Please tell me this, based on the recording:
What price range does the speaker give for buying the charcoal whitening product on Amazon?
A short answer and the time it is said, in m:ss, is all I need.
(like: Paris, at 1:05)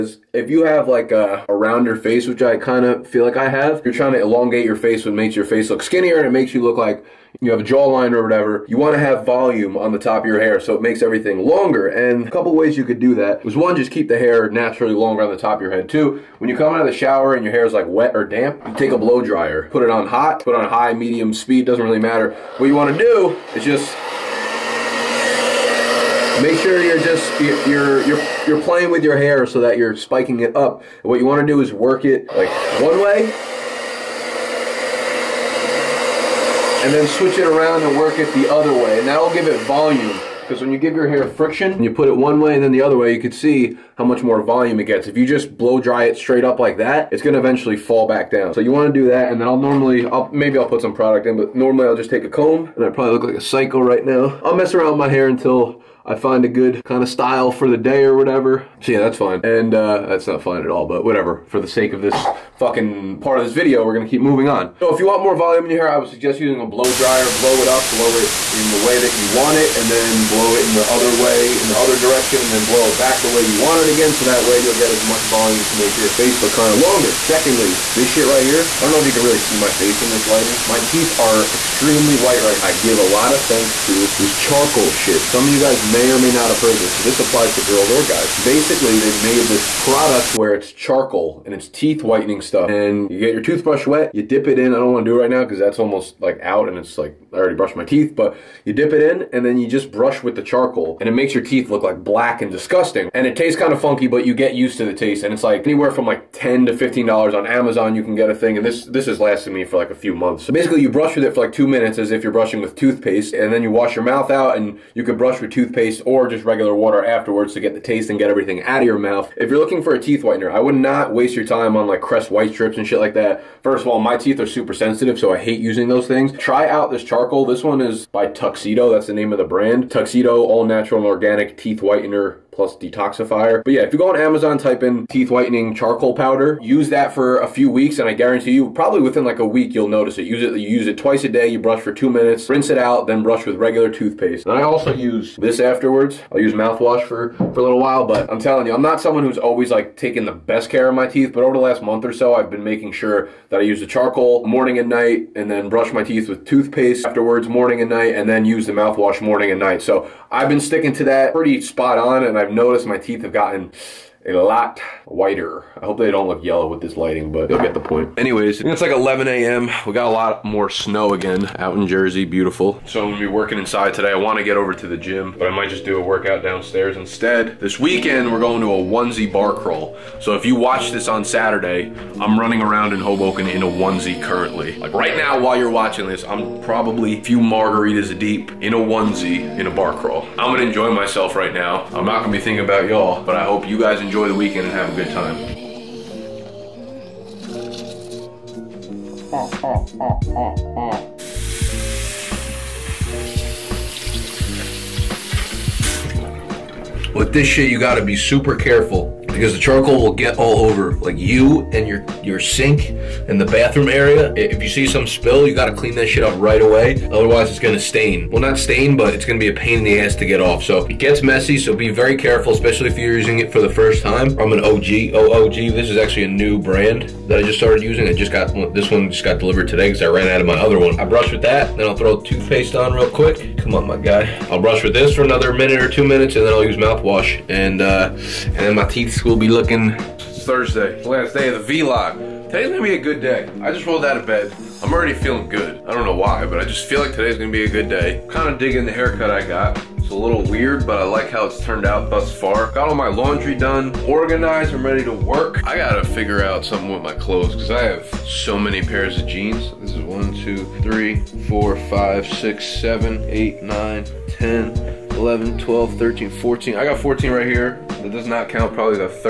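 $10 to $15, at 1:46.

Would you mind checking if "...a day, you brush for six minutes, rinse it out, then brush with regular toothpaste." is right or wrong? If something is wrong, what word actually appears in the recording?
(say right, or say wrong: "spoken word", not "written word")
wrong: "two", not "six".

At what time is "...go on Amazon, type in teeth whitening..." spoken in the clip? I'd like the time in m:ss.
2:13.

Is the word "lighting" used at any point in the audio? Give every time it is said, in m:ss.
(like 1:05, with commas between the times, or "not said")
1:20, 2:46.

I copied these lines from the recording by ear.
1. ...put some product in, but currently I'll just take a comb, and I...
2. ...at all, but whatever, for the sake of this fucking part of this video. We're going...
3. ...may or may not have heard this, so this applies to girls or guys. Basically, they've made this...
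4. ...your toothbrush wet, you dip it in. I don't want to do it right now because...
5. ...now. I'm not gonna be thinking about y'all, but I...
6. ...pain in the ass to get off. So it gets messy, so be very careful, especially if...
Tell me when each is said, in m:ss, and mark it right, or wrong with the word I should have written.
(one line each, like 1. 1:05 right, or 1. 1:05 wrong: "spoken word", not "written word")
1. 0:50 wrong: "normally", not "currently"
2. 1:00 right
3. 1:25 right
4. 1:33 right
5. 3:11 right
6. 3:39 right.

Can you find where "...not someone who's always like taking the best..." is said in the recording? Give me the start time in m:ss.
2:28.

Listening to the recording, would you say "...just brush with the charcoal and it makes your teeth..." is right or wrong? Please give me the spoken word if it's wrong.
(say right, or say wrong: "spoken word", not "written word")
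right.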